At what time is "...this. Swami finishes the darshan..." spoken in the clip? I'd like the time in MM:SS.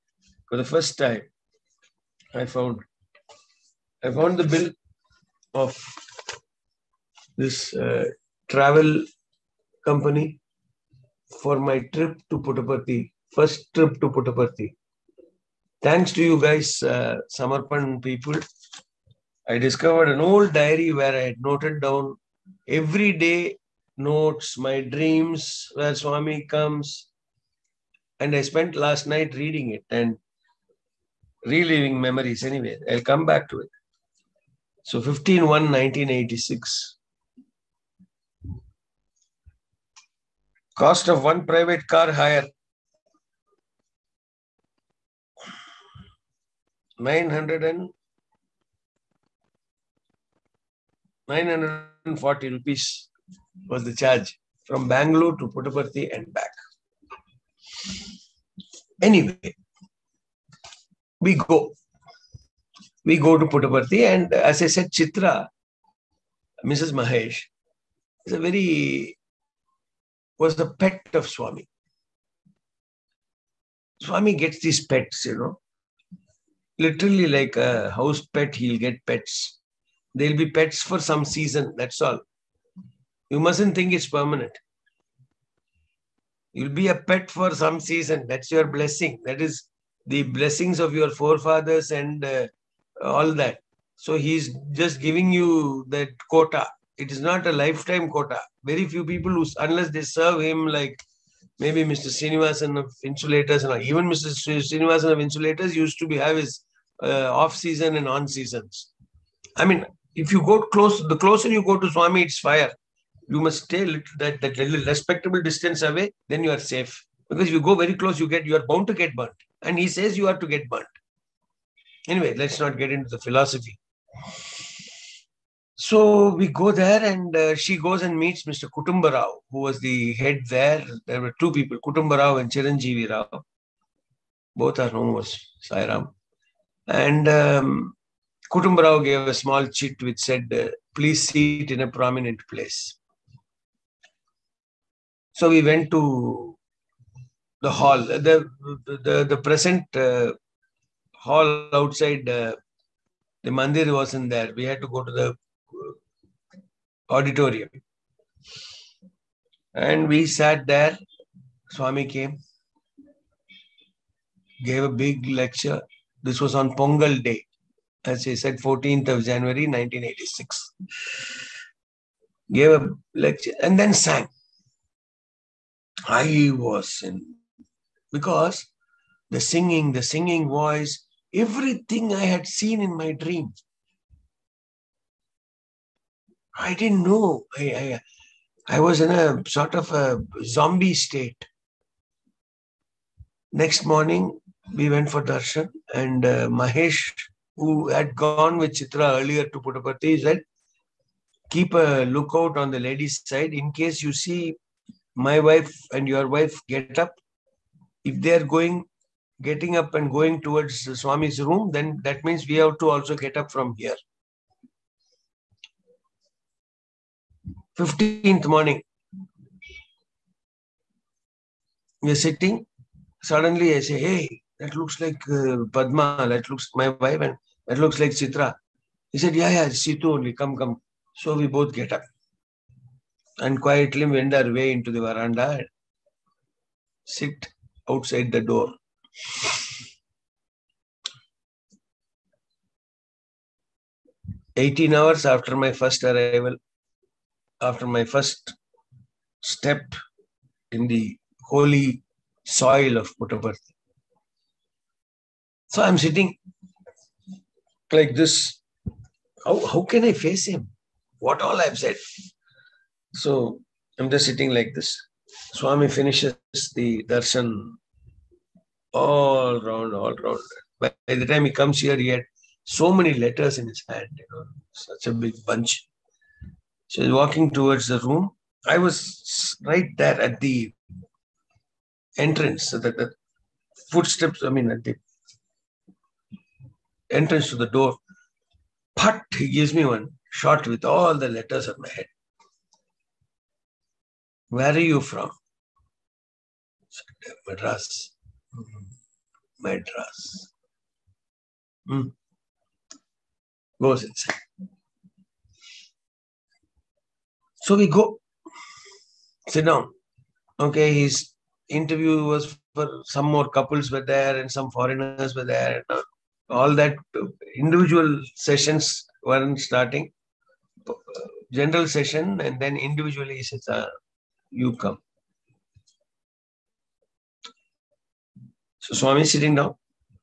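04:24.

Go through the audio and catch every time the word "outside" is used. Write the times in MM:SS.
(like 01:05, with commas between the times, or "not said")
02:31, 03:57.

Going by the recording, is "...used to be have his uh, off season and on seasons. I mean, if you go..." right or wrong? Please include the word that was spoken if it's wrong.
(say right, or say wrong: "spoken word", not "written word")
right.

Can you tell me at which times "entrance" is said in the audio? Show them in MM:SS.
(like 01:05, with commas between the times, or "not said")
04:42, 04:47.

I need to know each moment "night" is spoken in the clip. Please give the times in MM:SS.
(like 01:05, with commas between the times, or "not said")
00:29.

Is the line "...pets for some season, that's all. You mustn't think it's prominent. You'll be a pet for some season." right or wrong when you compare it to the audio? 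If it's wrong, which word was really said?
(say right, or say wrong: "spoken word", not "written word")
wrong: "permanent", not "prominent".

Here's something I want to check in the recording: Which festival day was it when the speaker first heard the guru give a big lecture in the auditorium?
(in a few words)
Pongal.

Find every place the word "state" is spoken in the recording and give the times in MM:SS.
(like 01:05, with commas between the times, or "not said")
03:10.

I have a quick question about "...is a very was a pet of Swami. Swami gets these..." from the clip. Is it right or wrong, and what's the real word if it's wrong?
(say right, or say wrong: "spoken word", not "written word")
right.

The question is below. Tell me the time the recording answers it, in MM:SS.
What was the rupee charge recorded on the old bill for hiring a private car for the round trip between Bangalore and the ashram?
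00:51.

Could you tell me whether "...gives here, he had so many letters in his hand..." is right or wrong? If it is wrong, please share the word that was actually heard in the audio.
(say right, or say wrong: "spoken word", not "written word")
wrong: "comes", not "gives".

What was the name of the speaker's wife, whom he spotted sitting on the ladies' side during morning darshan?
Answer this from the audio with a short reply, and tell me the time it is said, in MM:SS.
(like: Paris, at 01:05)
Padma, at 03:45.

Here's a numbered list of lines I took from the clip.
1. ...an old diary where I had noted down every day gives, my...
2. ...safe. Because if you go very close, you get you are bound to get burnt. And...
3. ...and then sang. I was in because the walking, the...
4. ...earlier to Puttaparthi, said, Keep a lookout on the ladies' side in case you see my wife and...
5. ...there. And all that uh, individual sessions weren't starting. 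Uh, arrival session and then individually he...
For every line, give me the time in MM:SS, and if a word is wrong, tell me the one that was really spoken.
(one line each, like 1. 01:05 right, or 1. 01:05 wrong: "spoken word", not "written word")
1. 00:20 wrong: "notes", not "gives"
2. 01:56 right
3. 02:53 wrong: "singing", not "walking"
4. 03:19 right
5. 05:15 wrong: "general", not "arrival".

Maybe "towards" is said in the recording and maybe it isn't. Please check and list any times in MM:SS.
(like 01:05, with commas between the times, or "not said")
03:30, 04:37.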